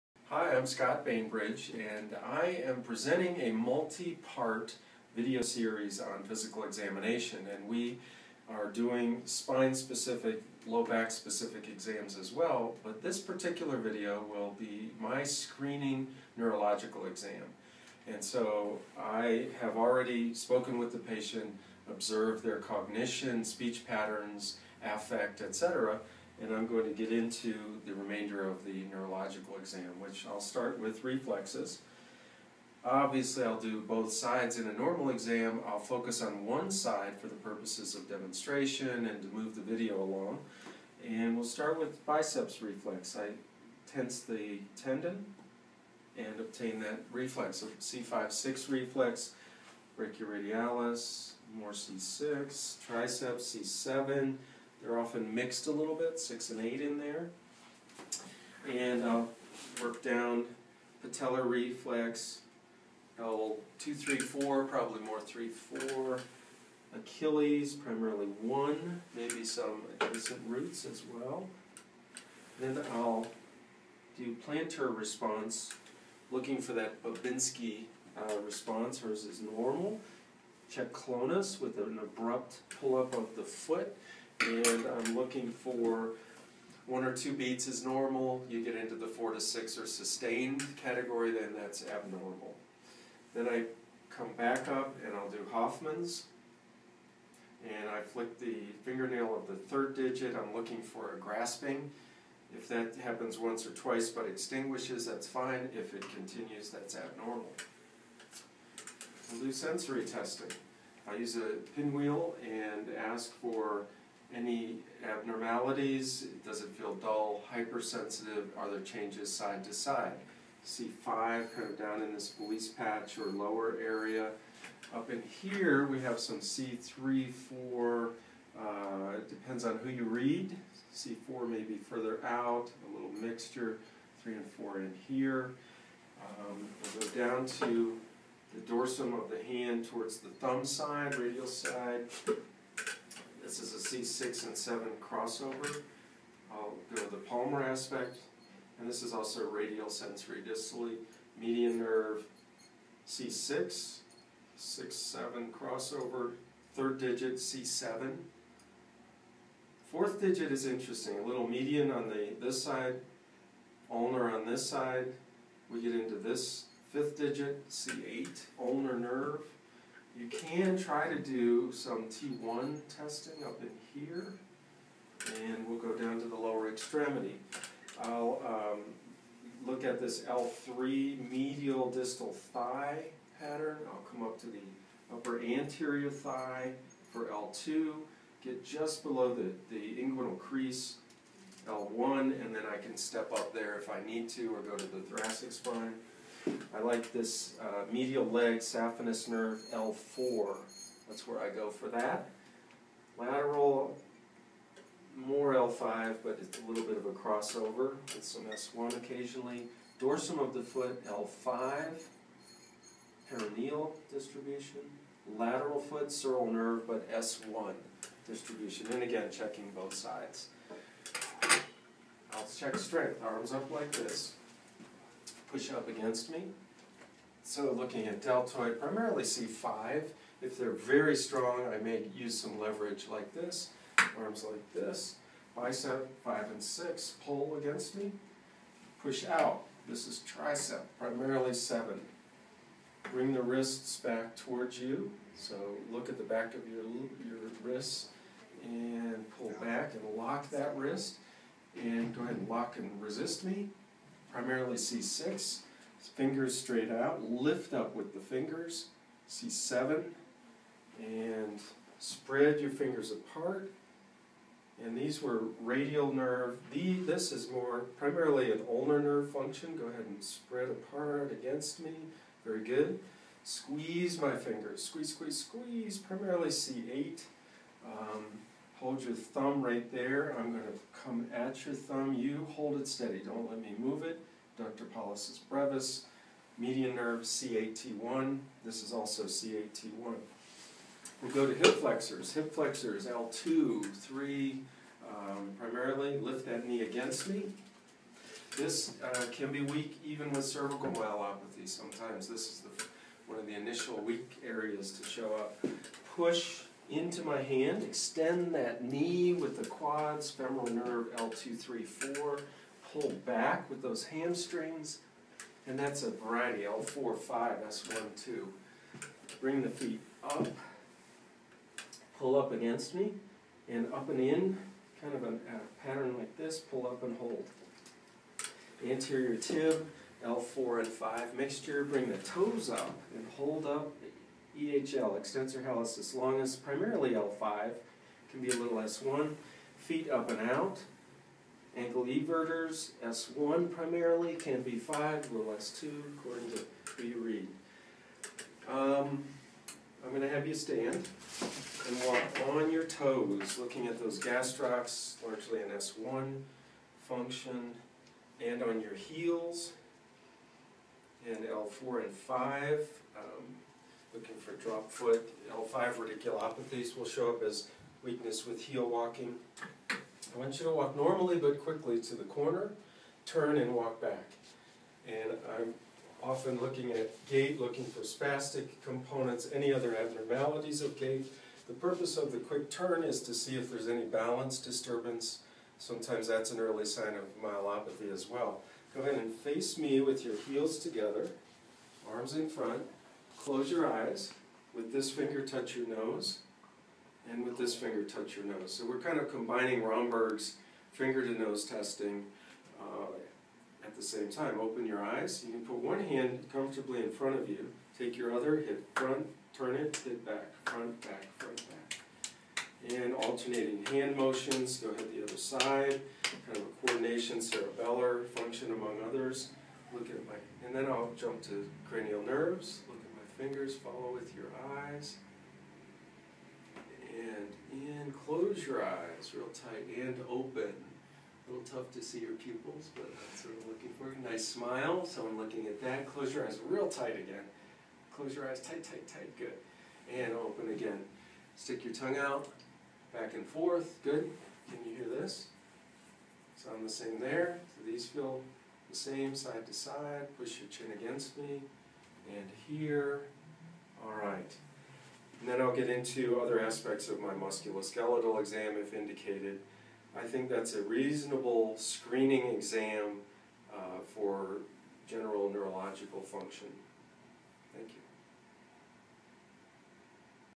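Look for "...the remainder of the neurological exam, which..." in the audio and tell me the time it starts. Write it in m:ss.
0:27.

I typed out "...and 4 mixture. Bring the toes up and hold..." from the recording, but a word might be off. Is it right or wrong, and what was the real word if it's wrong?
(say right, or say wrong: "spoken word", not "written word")
wrong: "5", not "4".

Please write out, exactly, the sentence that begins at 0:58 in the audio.
And I'll work down patellar reflex, L two, three, four, probably more three, four.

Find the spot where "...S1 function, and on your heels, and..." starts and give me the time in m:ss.
5:55.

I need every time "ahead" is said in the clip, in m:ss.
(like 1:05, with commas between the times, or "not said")
4:12, 4:29, 6:29, 6:54.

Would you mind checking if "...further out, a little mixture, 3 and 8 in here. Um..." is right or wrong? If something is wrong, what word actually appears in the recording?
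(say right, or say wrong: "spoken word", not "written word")
wrong: "4", not "8".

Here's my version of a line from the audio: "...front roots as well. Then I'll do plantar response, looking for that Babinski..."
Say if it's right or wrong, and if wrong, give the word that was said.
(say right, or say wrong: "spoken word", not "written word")
wrong: "adjacent", not "front".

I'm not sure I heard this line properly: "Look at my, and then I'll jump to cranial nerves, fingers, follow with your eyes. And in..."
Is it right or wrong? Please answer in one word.
right.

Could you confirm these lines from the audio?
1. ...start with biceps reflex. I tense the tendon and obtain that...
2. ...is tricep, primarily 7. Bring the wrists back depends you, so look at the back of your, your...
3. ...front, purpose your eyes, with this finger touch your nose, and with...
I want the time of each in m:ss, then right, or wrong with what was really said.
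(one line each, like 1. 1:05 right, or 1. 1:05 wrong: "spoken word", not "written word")
1. 0:41 right
2. 4:00 wrong: "towards", not "depends"
3. 6:32 wrong: "close", not "purpose".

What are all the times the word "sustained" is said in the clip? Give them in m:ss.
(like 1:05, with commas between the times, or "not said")
1:29.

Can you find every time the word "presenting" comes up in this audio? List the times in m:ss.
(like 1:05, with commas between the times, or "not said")
0:02.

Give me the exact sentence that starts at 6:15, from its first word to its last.
And I'm often looking at gait, looking for spastic components, any other abnormalities of gait.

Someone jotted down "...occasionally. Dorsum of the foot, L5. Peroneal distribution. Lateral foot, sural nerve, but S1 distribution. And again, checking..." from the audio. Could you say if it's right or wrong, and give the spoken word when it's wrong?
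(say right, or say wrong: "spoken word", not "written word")
right.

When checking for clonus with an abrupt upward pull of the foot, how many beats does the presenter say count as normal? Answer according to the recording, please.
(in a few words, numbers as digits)
1 or 2.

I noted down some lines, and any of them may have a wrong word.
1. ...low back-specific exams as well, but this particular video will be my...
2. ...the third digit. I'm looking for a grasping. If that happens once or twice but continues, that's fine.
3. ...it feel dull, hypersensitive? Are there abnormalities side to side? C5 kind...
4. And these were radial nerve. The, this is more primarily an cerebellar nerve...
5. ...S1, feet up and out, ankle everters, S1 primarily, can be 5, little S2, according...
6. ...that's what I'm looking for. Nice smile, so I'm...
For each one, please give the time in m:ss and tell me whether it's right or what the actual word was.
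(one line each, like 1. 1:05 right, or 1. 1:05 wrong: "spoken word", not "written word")
1. 0:10 right
2. 1:39 wrong: "extinguishes", not "continues"
3. 1:56 wrong: "changes", not "abnormalities"
4. 4:24 wrong: "ulnar", not "cerebellar"
5. 5:38 right
6. 7:13 right.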